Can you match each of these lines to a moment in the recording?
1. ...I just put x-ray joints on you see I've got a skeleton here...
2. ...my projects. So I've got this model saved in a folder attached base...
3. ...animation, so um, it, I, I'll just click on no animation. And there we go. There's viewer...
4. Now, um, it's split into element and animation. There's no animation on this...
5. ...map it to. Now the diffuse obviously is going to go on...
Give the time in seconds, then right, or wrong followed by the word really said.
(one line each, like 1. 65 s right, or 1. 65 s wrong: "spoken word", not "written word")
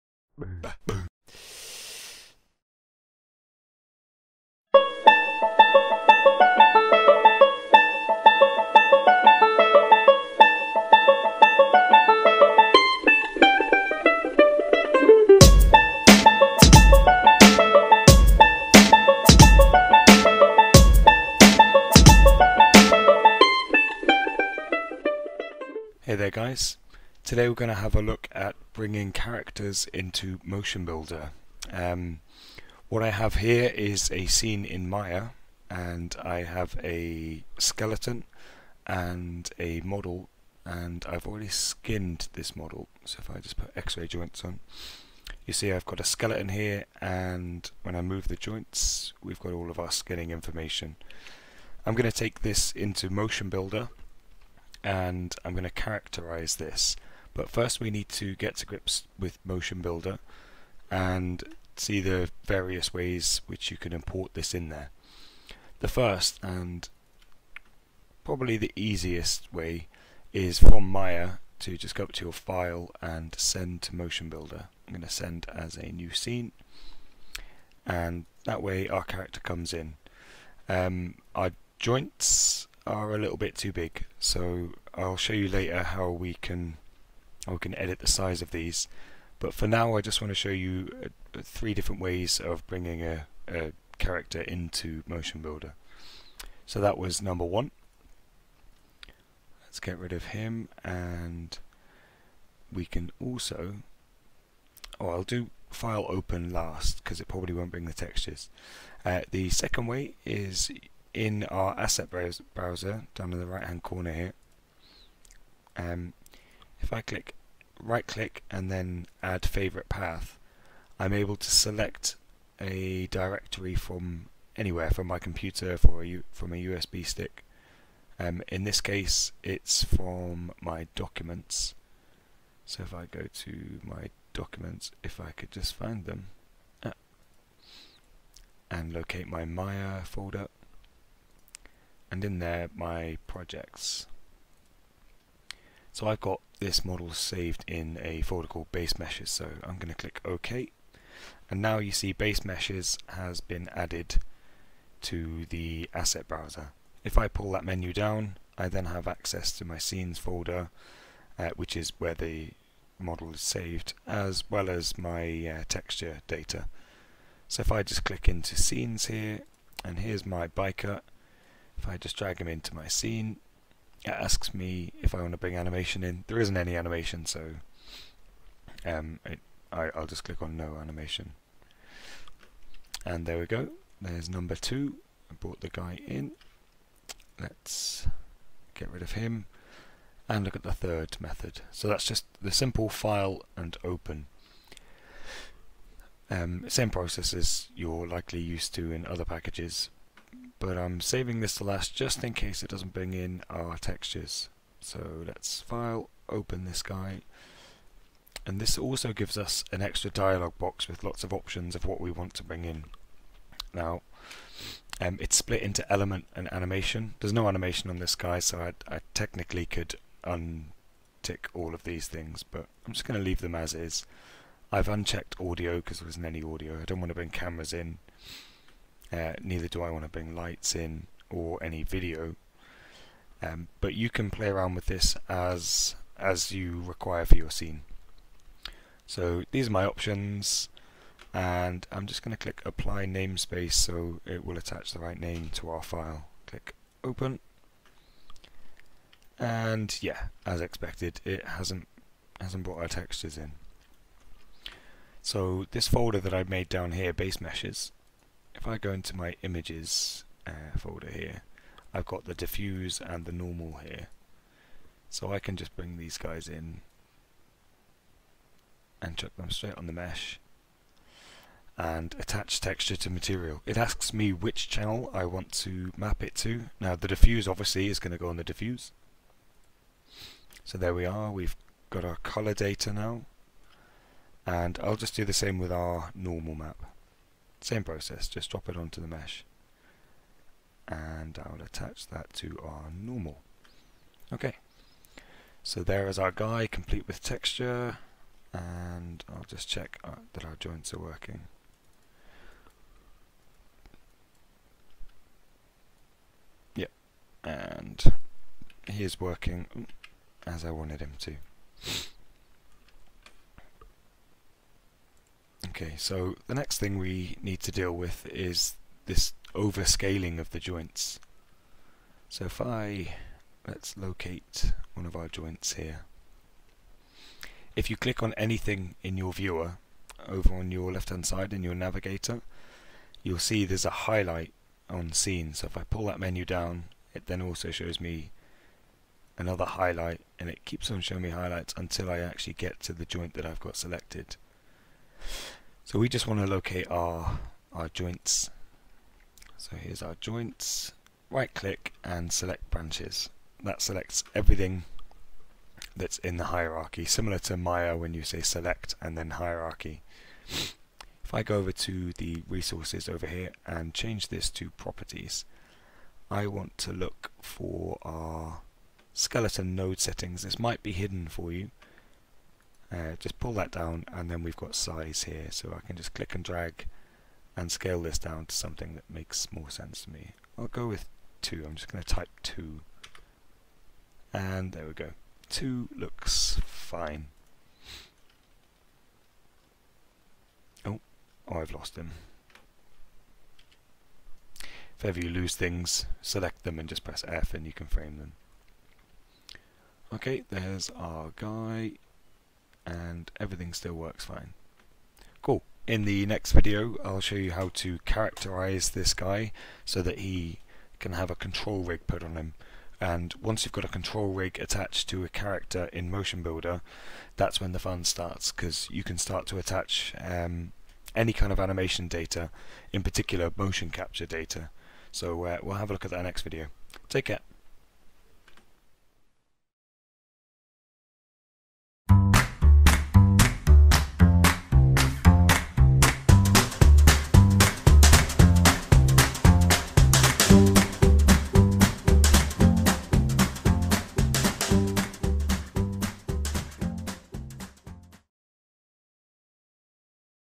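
1. 43 s right
2. 142 s wrong: "called", not "attached"
3. 176 s wrong: "number", not "viewer"
4. 213 s right
5. 275 s right.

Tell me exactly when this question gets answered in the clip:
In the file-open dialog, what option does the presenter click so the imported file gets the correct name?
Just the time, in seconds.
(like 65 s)
242 s.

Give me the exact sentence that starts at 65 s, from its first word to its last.
The first and probably the easiest way is from Maya to just go up to your file and send to Motion Builder.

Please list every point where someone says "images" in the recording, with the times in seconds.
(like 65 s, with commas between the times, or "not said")
259 s.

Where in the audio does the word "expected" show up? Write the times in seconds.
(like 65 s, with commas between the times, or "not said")
250 s.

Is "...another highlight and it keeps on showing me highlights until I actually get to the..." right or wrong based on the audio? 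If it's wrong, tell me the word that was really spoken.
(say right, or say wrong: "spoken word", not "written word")
right.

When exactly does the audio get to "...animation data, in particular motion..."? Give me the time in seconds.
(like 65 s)
421 s.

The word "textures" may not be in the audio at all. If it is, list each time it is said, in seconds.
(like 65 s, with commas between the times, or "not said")
107 s, 165 s, 203 s, 252 s, 272 s, 297 s.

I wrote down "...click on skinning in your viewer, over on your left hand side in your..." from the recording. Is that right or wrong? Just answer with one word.
wrong.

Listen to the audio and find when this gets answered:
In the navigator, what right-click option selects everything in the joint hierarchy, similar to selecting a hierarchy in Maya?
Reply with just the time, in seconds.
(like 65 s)
352 s.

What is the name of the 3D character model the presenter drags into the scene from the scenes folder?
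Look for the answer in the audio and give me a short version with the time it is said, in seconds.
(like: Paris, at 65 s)
biker, at 170 s.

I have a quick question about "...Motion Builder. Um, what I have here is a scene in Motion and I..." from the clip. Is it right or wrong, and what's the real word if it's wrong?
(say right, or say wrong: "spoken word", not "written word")
wrong: "Maya", not "Motion".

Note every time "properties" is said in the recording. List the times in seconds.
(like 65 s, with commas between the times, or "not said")
364 s.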